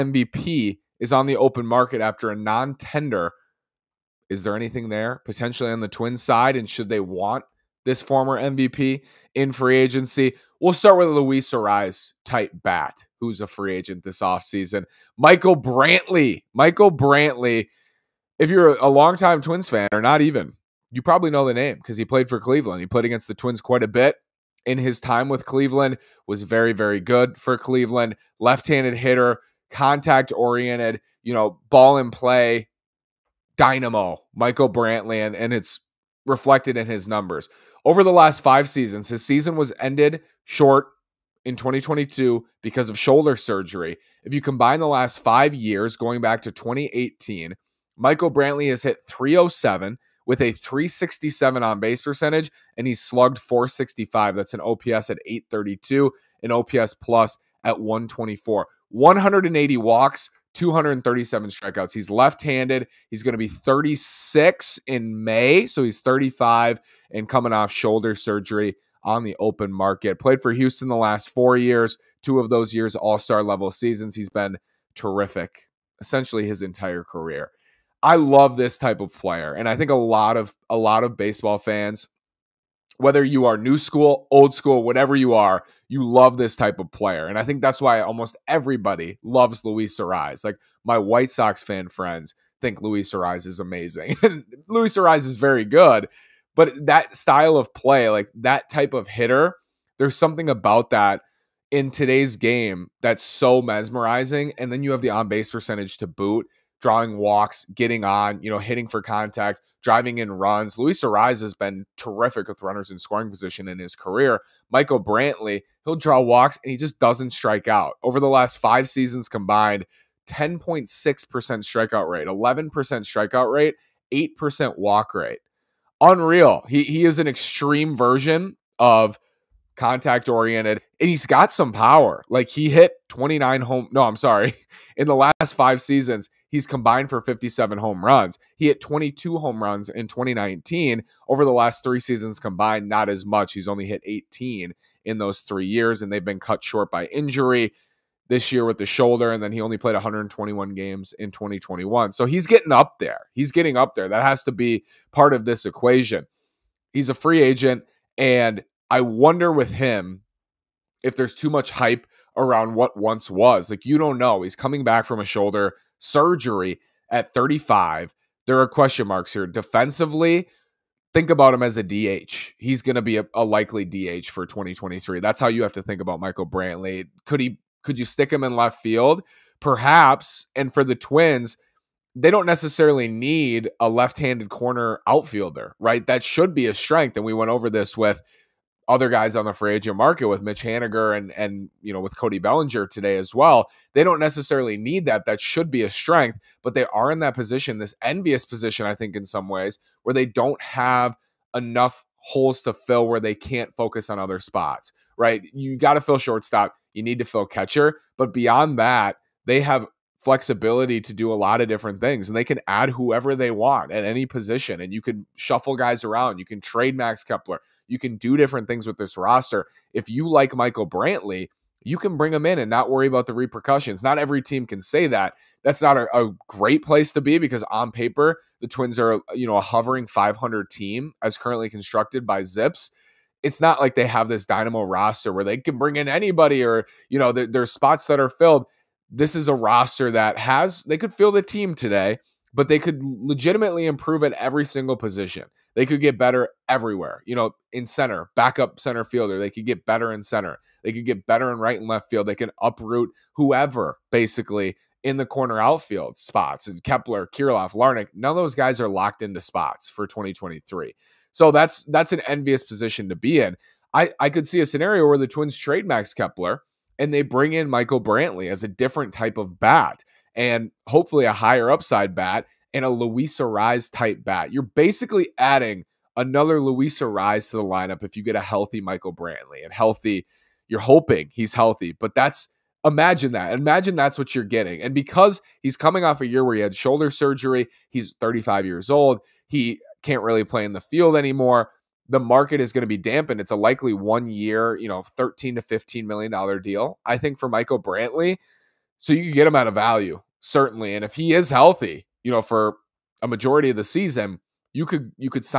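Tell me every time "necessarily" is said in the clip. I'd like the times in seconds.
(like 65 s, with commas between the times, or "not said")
182 s, 194 s.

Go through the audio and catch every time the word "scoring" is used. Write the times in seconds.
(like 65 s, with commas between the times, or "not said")
112 s.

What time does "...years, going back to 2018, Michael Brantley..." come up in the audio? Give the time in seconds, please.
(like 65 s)
45 s.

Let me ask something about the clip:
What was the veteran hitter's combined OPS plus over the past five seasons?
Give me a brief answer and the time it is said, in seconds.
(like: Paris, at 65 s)
124, at 56 s.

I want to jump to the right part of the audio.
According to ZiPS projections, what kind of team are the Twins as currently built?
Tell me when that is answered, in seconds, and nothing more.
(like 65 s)
230 s.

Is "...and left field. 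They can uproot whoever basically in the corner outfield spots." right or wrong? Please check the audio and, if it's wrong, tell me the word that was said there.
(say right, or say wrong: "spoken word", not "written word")
right.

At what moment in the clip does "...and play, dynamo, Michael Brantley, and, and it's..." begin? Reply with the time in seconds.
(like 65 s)
31 s.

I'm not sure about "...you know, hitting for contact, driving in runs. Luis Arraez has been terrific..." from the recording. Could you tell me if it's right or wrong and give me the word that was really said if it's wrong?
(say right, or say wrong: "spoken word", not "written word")
right.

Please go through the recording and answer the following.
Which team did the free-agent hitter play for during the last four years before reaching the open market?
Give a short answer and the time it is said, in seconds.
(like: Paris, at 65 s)
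Houston, at 70 s.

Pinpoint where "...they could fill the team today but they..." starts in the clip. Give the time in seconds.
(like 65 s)
240 s.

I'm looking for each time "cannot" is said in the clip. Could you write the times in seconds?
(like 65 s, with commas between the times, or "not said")
not said.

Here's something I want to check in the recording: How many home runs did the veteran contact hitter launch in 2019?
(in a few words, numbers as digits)
22.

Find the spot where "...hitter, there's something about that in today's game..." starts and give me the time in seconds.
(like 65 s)
99 s.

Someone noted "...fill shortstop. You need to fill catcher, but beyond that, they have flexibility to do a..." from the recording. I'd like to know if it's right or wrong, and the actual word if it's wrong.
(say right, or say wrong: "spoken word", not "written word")
right.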